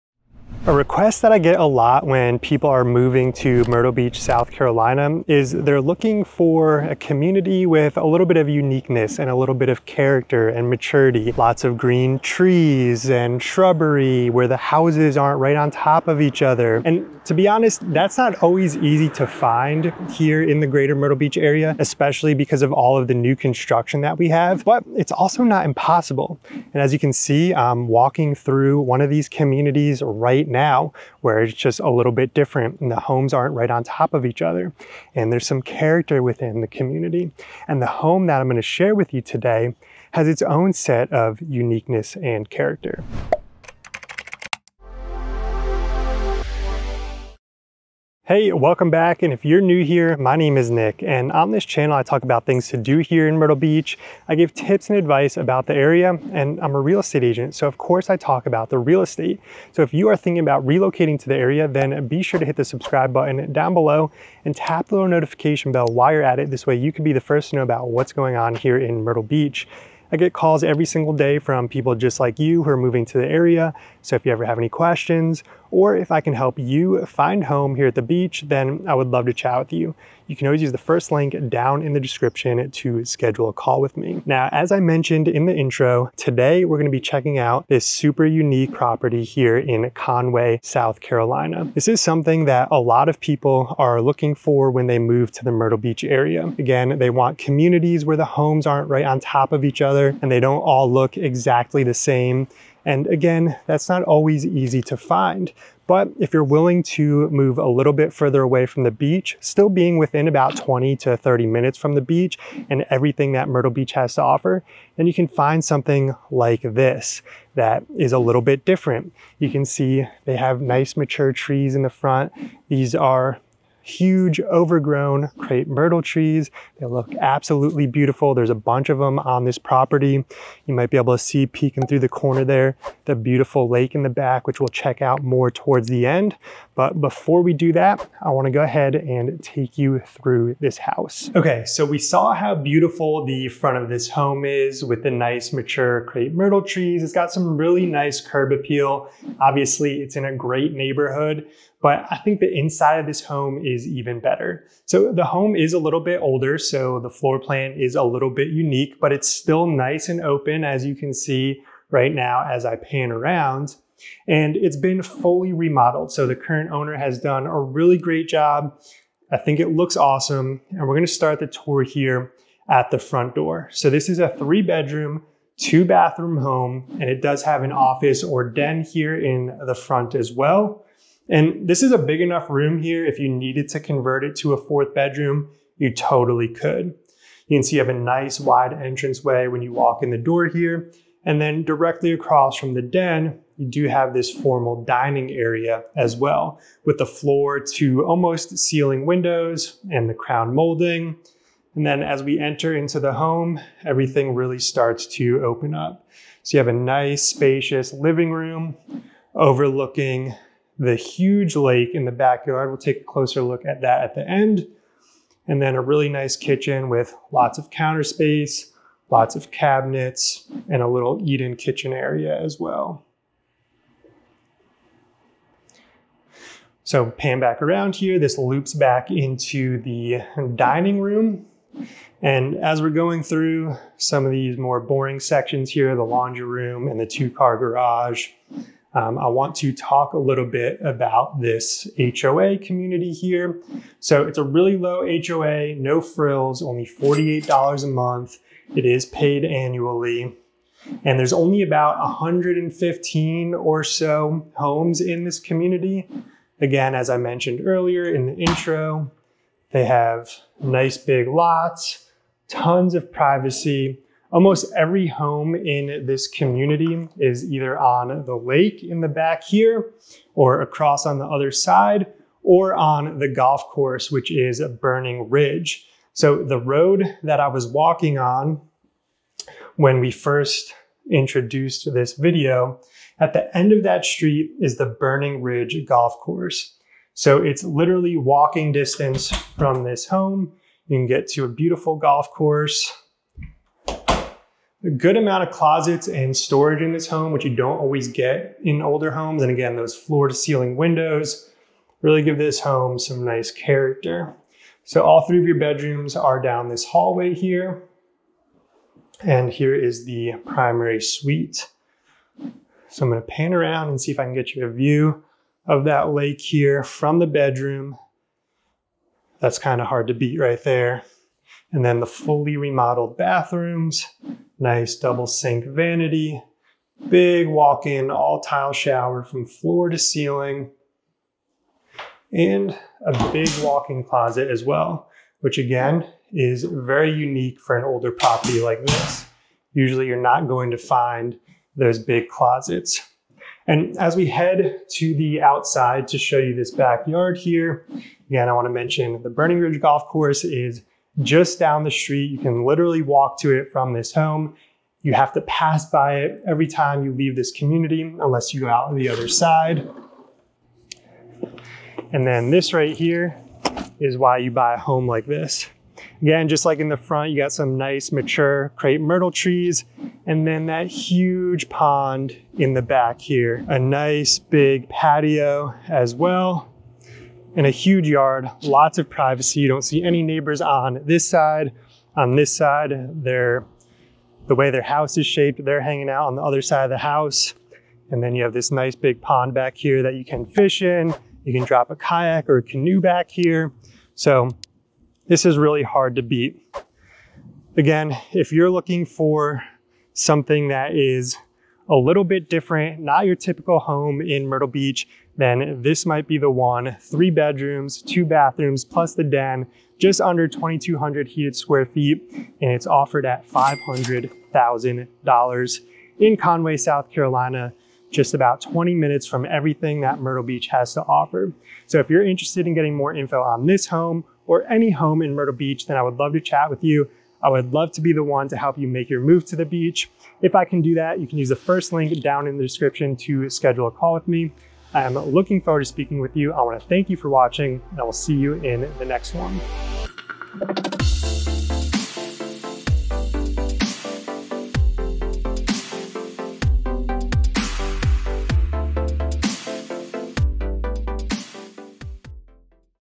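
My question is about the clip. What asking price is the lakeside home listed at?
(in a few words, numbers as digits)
$500,000.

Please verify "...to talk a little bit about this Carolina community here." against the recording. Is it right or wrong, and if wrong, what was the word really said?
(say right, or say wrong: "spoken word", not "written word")
wrong: "HOA", not "Carolina".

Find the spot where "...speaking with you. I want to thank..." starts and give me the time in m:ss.
7:15.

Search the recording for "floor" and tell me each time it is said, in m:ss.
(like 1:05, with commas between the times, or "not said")
2:37, 3:17, 4:59, 5:29.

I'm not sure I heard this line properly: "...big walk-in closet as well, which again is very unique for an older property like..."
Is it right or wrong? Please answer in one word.
right.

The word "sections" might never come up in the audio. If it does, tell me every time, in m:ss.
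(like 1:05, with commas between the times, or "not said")
3:55.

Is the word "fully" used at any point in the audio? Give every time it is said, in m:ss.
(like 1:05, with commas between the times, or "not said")
2:45, 5:22.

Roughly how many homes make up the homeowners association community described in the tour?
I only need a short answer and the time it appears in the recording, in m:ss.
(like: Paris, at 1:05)
115, at 4:11.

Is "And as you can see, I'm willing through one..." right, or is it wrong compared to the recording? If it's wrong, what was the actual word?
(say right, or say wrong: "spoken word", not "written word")
wrong: "walking", not "willing".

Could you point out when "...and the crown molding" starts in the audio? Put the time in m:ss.
3:19.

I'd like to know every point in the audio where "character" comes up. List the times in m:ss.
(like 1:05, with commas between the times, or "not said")
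0:09, 0:35, 0:42, 5:03.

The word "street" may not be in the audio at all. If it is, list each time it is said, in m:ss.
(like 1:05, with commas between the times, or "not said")
4:44, 5:51.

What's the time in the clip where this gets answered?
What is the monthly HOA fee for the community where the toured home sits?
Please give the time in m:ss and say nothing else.
4:06.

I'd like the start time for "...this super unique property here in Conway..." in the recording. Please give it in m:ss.
1:27.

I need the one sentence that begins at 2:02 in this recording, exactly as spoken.
These are huge overgrown crepe myrtle trees.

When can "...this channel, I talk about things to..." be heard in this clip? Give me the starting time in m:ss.
0:51.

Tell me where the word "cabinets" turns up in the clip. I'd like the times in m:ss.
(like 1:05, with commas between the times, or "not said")
3:39.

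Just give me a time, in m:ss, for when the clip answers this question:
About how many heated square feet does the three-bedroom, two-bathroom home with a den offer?
6:49.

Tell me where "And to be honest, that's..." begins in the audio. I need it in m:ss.
0:16.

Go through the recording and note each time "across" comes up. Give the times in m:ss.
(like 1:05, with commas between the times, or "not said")
3:12, 4:30.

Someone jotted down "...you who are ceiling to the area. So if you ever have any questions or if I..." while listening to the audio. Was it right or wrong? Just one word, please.
wrong.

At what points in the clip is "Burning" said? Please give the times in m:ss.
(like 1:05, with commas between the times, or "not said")
4:34, 4:44, 5:49.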